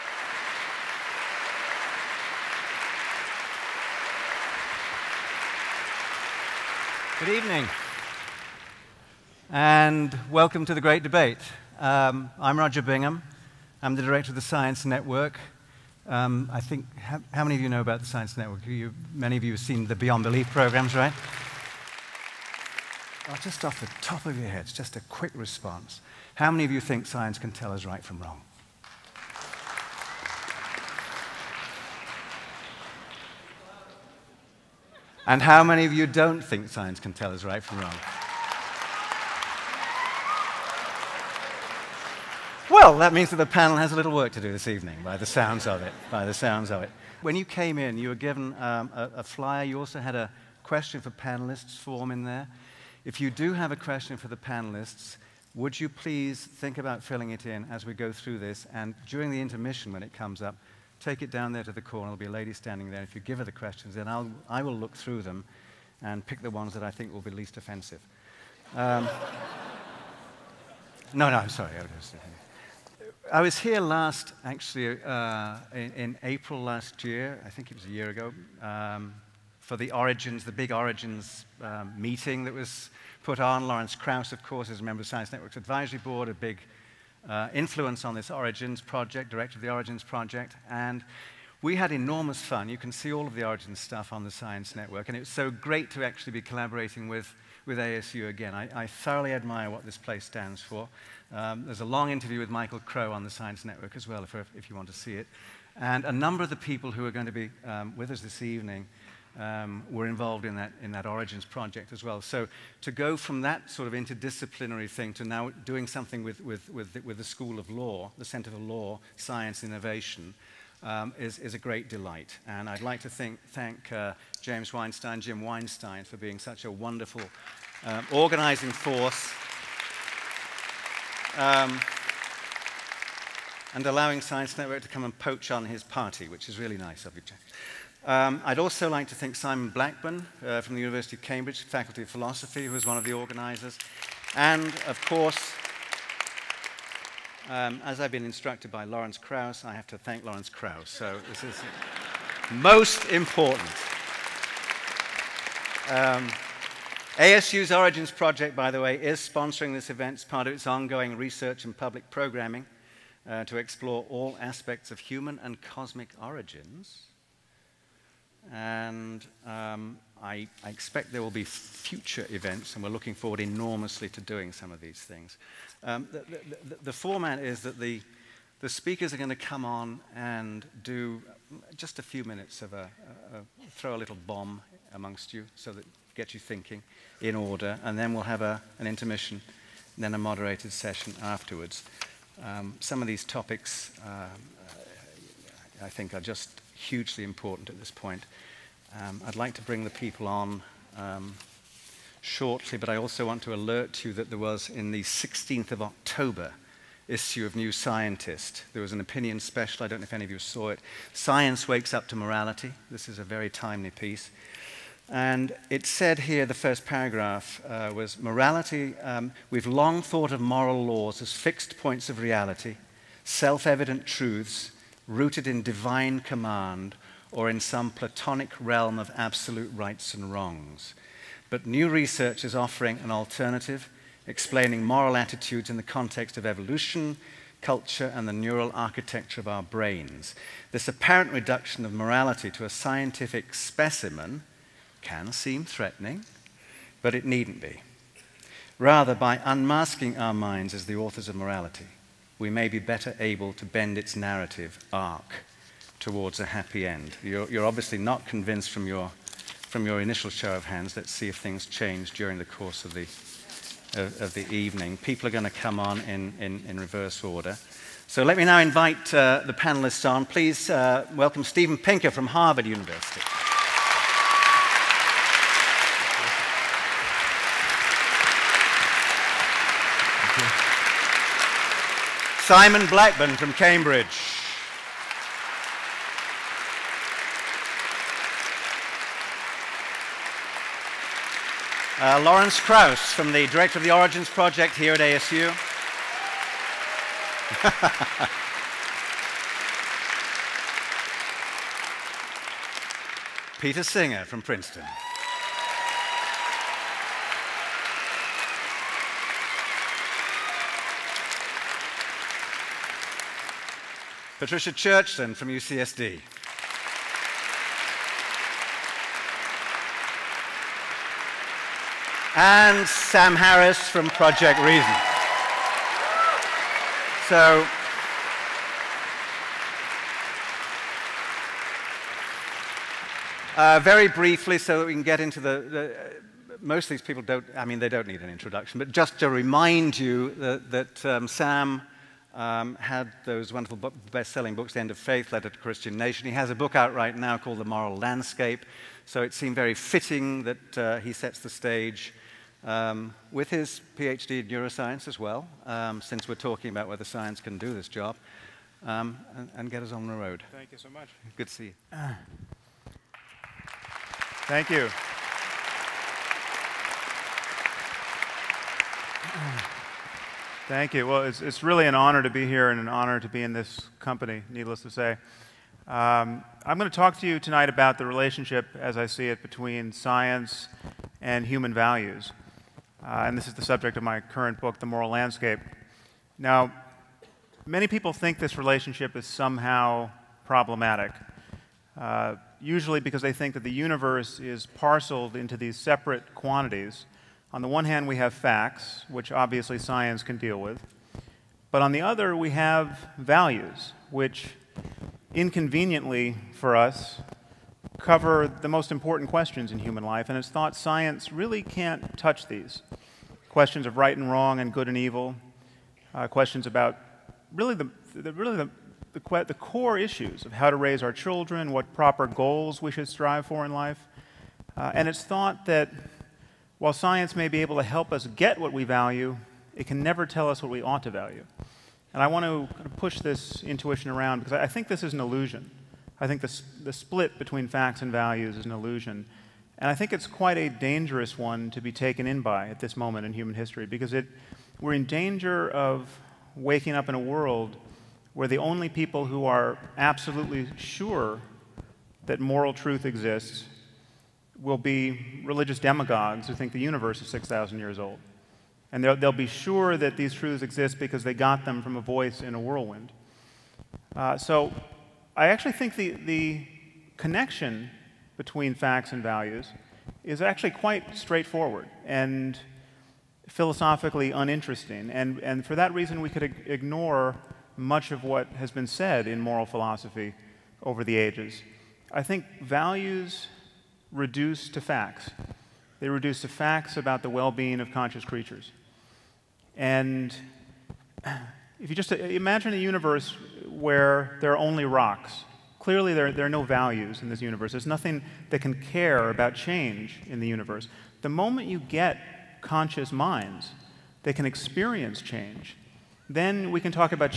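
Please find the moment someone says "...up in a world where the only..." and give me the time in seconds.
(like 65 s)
446 s.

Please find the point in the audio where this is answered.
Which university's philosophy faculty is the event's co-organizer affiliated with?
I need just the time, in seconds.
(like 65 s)
140 s.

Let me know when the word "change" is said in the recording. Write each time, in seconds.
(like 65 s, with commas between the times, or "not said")
261 s, 499 s, 505 s.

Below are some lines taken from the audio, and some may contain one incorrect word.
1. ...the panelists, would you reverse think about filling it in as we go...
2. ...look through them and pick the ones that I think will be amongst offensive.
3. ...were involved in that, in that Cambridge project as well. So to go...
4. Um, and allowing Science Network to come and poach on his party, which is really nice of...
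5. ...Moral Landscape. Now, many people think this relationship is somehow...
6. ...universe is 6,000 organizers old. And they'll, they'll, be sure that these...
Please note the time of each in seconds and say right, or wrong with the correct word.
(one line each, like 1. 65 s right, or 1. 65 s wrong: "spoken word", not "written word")
1. 54 s wrong: "please", not "reverse"
2. 64 s wrong: "least", not "amongst"
3. 109 s wrong: "Origins", not "Cambridge"
4. 131 s right
5. 384 s right
6. 456 s wrong: "years", not "organizers".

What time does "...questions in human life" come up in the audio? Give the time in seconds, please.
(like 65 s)
409 s.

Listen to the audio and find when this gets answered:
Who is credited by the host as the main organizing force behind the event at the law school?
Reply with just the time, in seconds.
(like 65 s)
124 s.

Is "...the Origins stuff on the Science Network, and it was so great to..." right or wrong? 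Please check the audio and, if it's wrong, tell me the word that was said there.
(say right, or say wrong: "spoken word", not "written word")
right.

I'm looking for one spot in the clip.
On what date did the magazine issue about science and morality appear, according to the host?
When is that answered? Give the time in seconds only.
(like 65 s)
205 s.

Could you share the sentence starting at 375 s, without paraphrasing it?
Um, I'm going to talk to you tonight about the relationship, as I see it, between science and human values.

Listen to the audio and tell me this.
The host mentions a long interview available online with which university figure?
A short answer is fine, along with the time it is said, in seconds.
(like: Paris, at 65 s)
Michael Crow, at 102 s.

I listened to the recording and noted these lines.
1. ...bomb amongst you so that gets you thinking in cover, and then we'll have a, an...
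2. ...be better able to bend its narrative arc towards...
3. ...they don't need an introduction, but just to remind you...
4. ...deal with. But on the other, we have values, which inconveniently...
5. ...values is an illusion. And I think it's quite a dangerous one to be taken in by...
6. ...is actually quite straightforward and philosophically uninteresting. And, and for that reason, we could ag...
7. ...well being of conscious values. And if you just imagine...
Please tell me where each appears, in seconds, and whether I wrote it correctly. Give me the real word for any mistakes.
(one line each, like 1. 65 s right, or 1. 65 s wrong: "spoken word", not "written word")
1. 184 s wrong: "order", not "cover"
2. 252 s right
3. 337 s right
4. 400 s right
5. 438 s right
6. 470 s right
7. 487 s wrong: "creatures", not "values".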